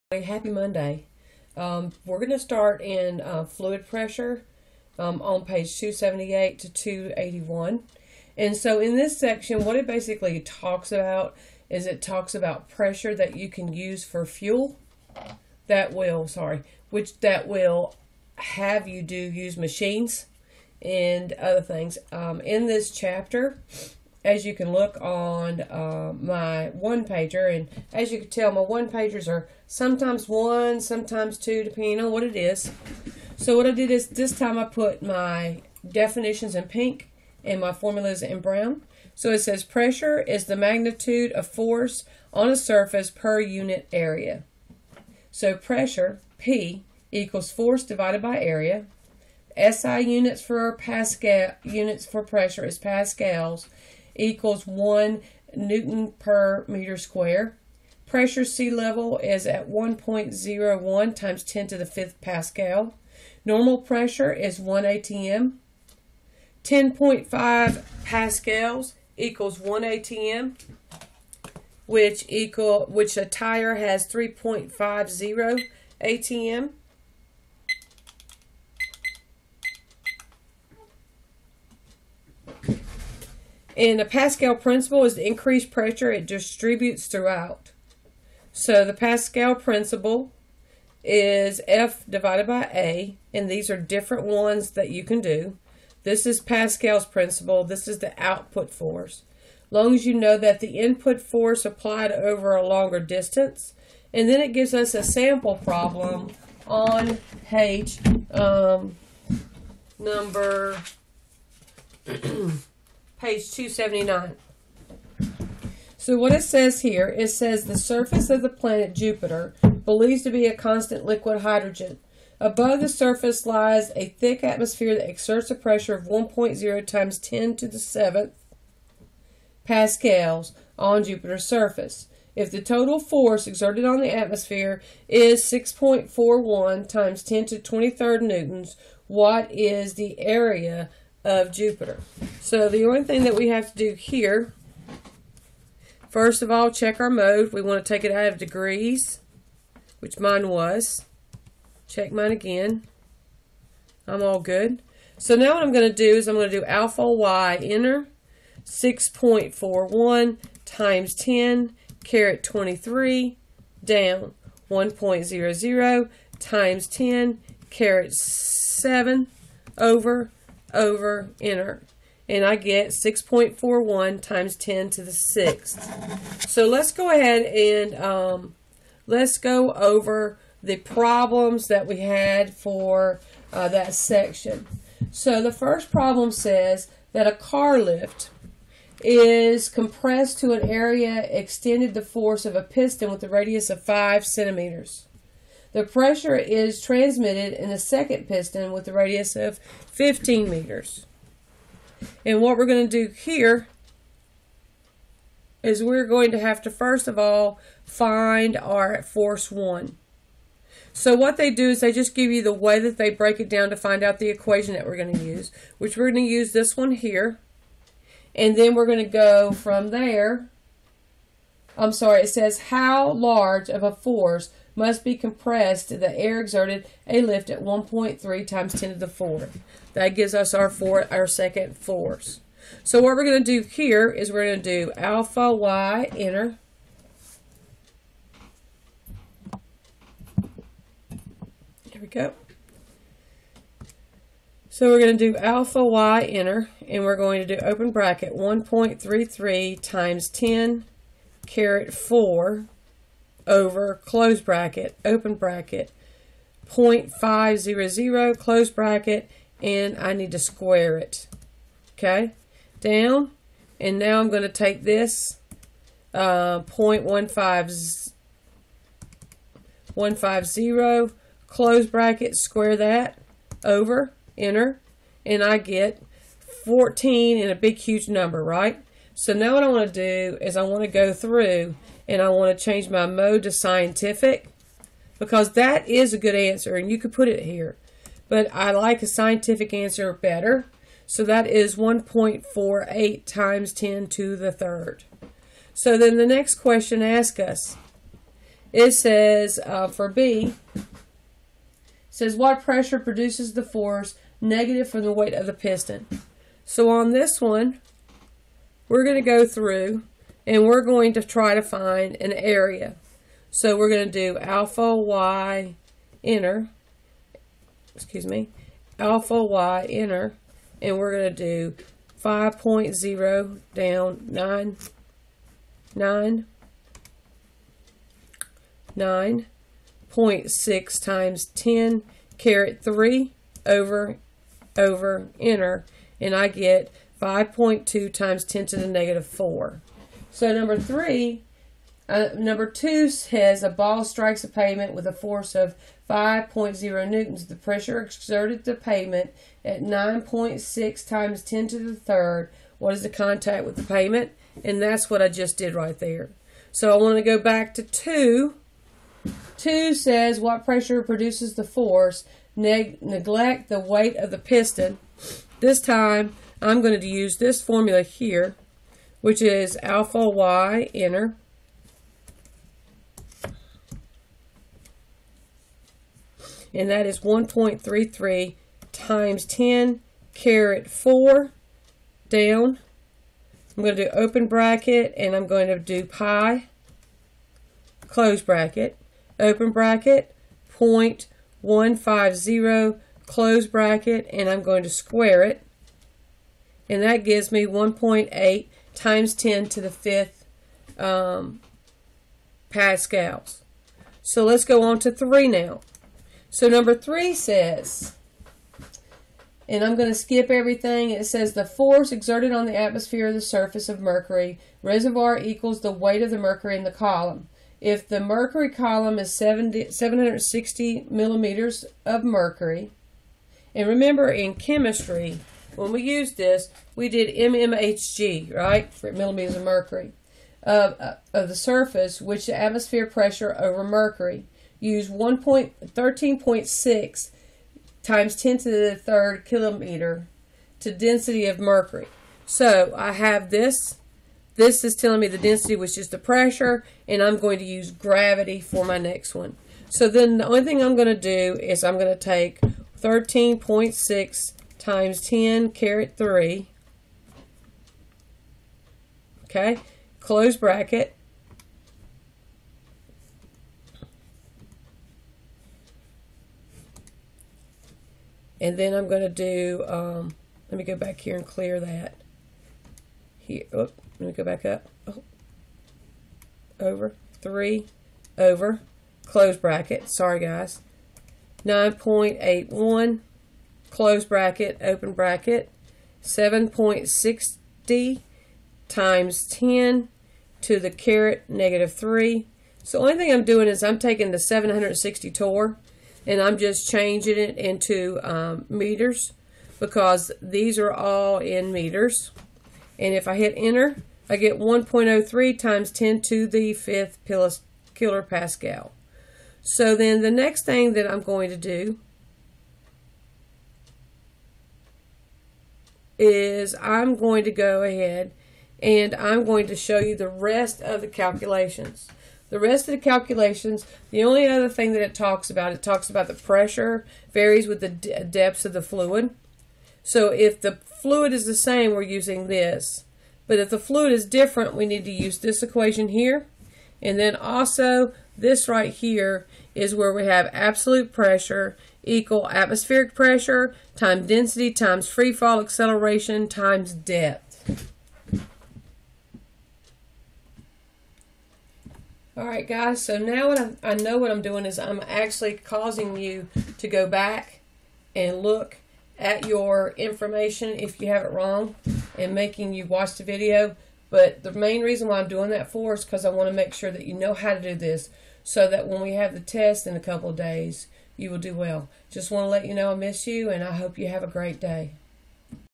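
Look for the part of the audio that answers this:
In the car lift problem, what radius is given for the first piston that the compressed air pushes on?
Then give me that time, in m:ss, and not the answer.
3:13.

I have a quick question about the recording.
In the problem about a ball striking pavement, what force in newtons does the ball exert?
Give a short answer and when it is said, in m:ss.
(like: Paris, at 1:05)
5.0 newtons, at 5:46.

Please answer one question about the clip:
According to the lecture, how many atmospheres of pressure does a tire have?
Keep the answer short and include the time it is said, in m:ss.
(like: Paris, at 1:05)
3.50 atm, at 1:14.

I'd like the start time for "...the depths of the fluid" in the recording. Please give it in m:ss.
8:47.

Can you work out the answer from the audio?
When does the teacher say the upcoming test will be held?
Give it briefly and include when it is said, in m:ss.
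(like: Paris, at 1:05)
in a couple of days, at 9:29.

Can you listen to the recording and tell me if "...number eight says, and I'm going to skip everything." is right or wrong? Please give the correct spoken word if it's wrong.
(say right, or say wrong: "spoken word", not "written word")
wrong: "three", not "eight".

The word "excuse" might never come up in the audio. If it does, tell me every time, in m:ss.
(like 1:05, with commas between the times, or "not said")
5:17.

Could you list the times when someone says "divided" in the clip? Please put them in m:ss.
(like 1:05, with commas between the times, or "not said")
0:47, 1:32.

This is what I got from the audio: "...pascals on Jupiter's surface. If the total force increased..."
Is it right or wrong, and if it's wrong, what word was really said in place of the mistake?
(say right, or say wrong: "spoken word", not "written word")
wrong: "exerted", not "increased".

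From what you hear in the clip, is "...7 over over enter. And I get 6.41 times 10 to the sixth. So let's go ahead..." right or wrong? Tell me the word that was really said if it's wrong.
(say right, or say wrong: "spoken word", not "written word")
right.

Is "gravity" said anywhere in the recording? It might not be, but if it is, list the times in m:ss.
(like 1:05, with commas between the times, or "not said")
7:27.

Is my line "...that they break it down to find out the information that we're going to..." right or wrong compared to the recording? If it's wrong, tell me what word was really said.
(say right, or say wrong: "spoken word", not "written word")
wrong: "equation", not "information".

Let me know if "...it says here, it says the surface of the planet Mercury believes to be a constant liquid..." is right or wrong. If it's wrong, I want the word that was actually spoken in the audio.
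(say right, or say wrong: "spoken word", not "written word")
wrong: "Jupiter", not "Mercury".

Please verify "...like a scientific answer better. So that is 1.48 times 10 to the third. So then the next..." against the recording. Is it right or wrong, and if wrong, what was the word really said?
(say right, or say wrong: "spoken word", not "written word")
right.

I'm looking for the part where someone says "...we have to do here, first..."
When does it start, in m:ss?
2:23.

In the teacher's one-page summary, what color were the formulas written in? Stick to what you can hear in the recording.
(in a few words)
brown.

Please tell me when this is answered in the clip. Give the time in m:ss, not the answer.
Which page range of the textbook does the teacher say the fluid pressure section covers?
0:05.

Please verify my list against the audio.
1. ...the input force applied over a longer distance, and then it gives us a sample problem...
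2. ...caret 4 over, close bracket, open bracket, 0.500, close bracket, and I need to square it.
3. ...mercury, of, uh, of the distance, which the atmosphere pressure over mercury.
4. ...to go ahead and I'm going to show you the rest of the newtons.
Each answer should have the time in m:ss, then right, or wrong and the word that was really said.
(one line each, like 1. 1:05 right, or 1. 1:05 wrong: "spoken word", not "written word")
1. 1:40 right
2. 4:11 right
3. 7:09 wrong: "surface", not "distance"
4. 8:37 wrong: "calculations", not "newtons".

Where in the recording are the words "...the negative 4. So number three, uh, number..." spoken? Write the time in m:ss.
5:38.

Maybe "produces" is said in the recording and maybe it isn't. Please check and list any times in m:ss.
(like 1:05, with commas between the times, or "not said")
5:02, 6:01.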